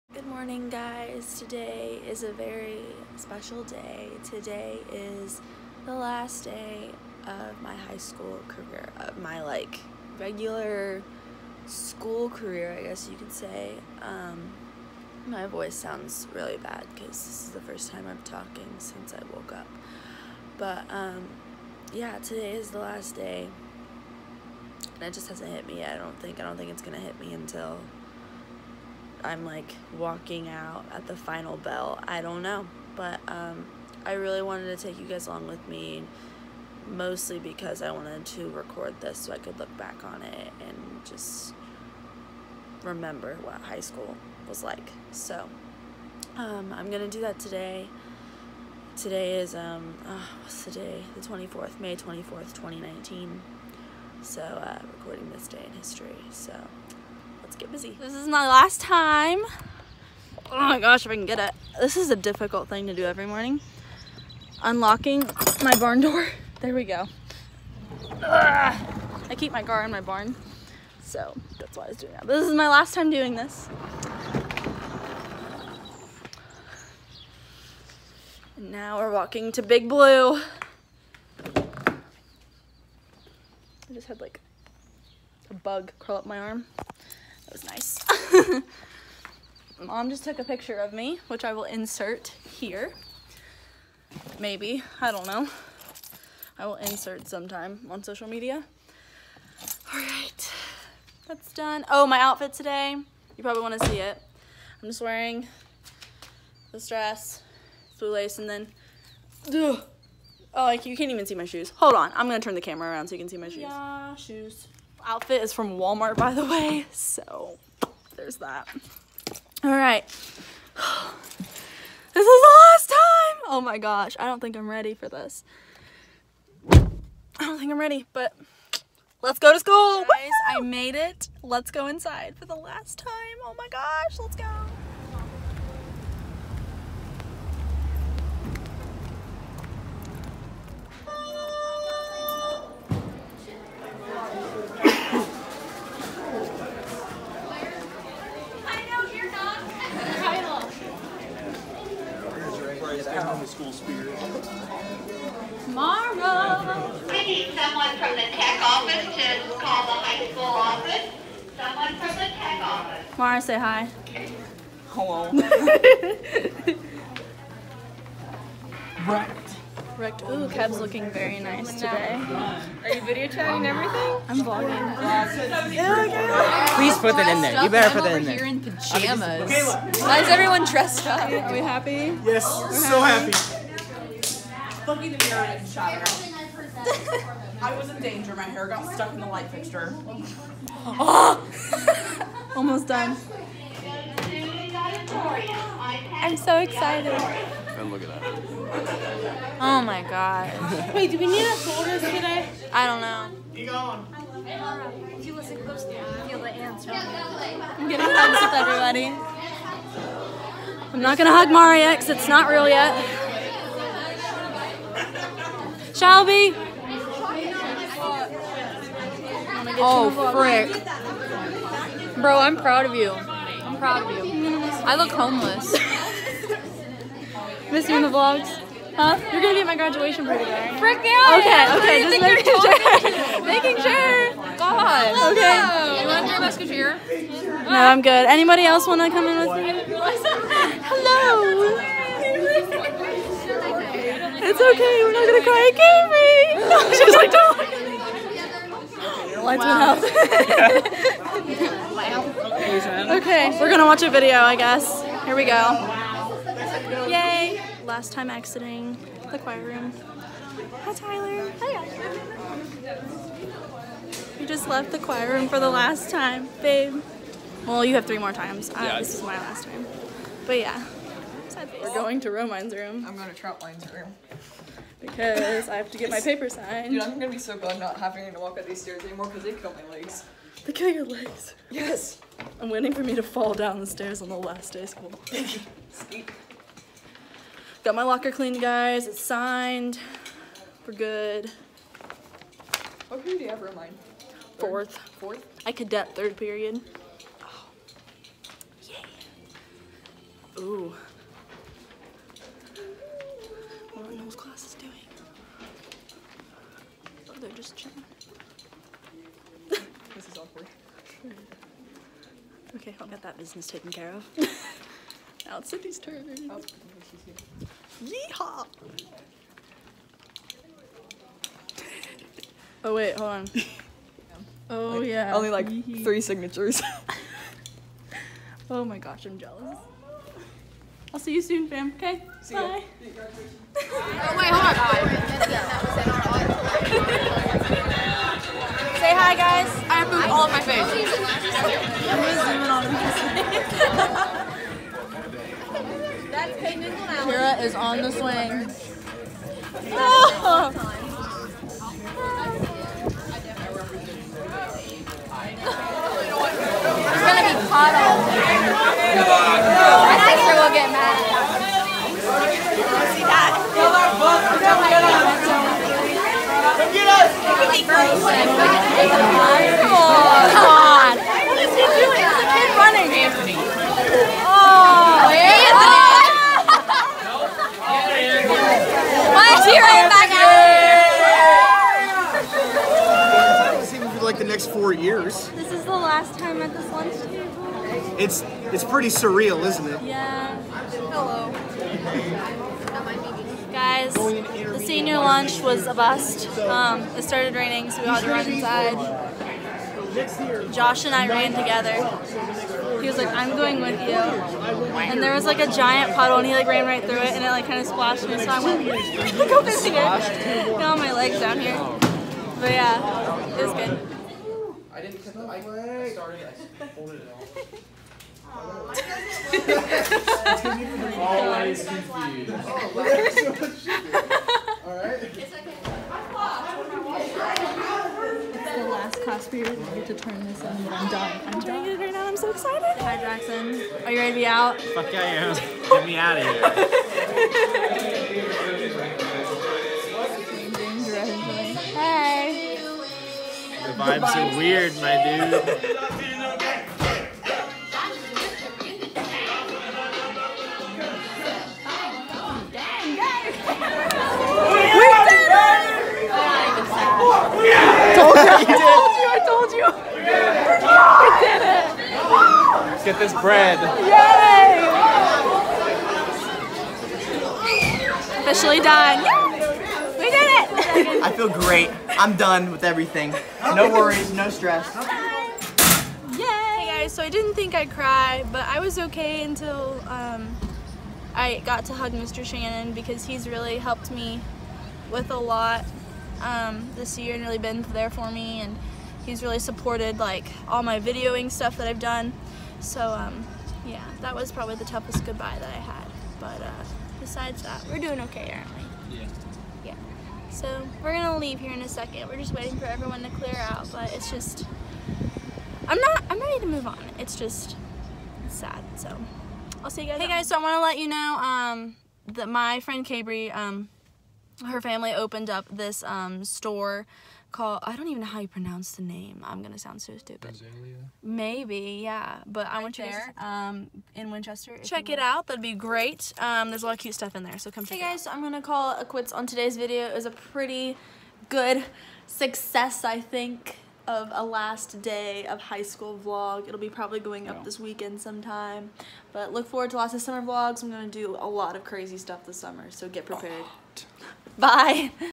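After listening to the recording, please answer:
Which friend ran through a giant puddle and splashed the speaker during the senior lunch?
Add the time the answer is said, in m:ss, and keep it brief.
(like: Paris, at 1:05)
Josh, at 6:40.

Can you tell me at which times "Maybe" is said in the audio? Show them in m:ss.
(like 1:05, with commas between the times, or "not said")
1:34, 8:41.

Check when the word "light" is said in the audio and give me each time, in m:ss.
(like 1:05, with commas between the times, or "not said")
3:09, 4:09.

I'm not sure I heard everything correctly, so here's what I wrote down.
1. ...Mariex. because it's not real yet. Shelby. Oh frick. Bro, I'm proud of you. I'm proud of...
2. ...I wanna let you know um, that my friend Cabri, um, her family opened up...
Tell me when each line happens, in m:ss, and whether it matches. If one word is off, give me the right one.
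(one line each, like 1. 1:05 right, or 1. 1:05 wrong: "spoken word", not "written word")
1. 3:31 right
2. 8:30 right.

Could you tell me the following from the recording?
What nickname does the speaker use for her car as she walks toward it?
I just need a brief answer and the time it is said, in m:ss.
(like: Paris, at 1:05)
Big Blue, at 1:19.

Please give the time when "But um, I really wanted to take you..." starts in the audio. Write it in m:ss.
0:32.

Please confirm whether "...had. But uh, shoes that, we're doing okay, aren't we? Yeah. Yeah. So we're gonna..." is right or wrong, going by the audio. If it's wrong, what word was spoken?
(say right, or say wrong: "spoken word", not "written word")
wrong: "besides", not "shoes".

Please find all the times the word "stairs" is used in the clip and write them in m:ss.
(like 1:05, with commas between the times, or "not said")
4:38, 4:43.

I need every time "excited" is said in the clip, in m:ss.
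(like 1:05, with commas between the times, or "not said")
3:16, 7:12.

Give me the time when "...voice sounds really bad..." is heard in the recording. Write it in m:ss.
0:15.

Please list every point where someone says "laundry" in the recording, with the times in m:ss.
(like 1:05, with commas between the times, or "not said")
not said.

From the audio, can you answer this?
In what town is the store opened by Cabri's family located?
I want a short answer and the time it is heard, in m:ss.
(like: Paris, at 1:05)
Winchester, at 8:44.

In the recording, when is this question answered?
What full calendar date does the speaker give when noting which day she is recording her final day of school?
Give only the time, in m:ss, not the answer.
0:51.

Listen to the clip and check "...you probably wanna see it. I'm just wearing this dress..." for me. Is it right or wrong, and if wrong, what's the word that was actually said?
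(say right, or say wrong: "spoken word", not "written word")
right.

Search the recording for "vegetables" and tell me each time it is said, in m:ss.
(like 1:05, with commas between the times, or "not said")
not said.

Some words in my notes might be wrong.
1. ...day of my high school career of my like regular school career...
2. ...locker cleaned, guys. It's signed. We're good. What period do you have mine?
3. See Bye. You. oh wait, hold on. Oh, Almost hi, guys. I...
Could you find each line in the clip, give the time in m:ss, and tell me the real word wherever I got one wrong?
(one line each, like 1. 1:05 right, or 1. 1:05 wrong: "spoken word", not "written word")
1. 0:06 right
2. 4:48 right
3. 5:32 wrong: "Say", not "Almost".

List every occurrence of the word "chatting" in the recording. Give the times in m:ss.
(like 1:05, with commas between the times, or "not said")
2:53.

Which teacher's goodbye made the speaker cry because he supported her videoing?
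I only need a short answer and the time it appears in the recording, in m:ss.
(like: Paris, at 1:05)
Mr. Shannon, at 8:02.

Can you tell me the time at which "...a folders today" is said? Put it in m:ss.
3:21.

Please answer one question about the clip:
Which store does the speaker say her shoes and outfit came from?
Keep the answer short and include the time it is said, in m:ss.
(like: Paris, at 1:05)
Walmart, at 1:55.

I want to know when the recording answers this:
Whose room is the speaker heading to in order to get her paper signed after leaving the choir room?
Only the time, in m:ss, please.
4:33.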